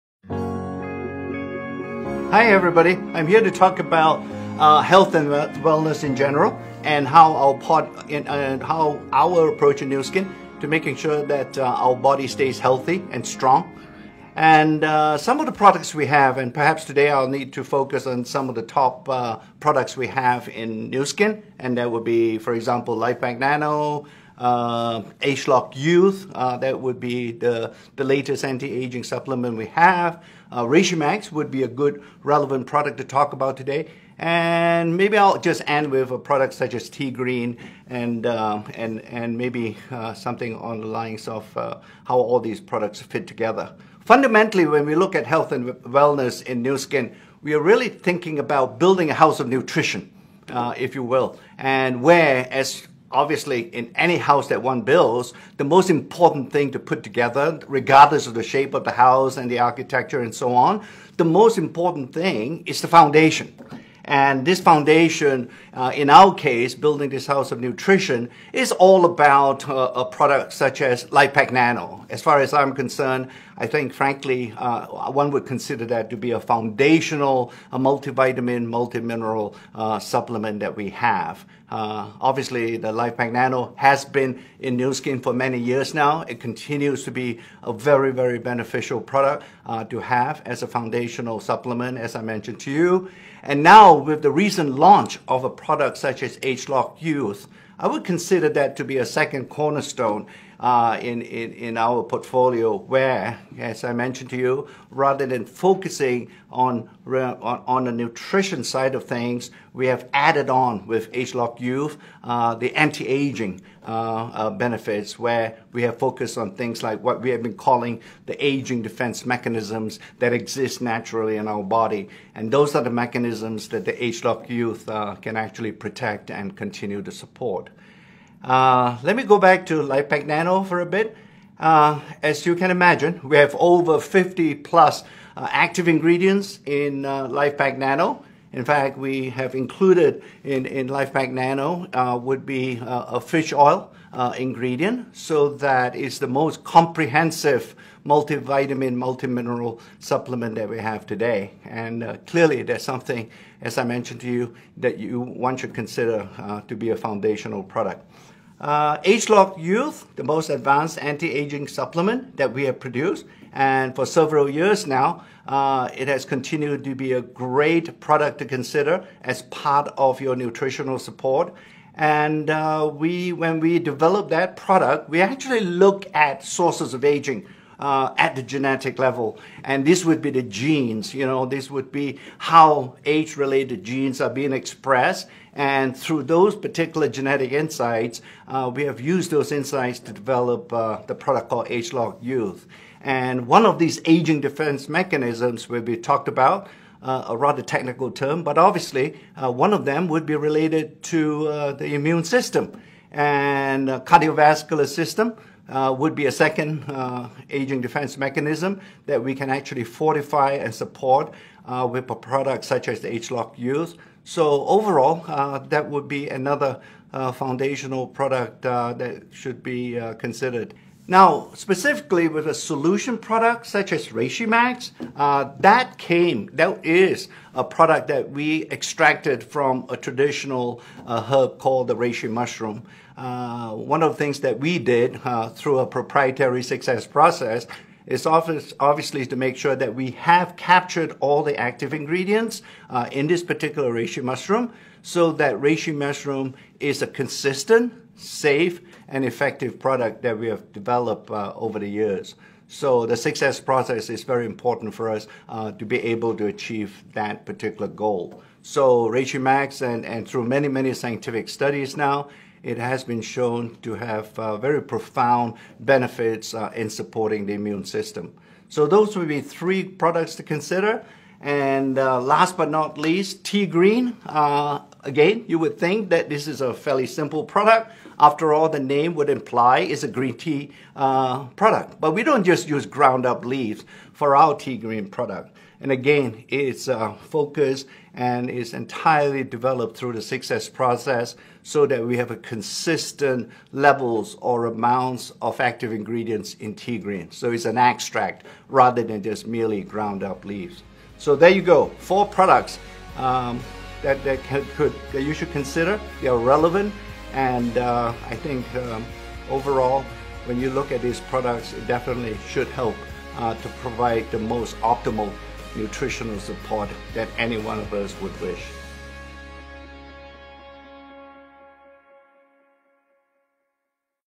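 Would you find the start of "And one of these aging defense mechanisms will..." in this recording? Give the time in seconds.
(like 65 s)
193 s.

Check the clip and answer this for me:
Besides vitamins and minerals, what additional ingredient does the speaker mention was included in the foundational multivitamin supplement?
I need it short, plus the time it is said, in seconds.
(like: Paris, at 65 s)
Fish oil, at 143 s.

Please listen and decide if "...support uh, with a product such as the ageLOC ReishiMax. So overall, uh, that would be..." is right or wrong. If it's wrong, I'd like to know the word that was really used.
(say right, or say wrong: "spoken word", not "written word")
wrong: "Youth", not "ReishiMax".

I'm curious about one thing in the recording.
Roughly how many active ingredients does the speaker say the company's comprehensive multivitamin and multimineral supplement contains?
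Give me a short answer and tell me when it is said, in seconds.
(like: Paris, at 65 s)
50+, at 133 s.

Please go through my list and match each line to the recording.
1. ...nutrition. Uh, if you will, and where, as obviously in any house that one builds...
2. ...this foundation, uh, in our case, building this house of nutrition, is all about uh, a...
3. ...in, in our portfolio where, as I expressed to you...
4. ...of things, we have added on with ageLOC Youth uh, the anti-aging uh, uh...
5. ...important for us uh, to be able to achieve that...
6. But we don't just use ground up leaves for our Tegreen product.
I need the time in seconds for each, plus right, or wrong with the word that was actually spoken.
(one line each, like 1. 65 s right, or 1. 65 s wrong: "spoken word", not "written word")
1. 49 s right
2. 64 s right
3. 101 s wrong: "mentioned", not "expressed"
4. 108 s right
5. 254 s right
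6. 281 s right.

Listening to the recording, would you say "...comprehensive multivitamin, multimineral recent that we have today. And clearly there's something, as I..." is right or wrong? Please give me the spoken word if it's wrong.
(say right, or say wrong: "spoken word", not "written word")
wrong: "supplement", not "recent".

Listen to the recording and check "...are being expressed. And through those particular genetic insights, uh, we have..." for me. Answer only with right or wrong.
right.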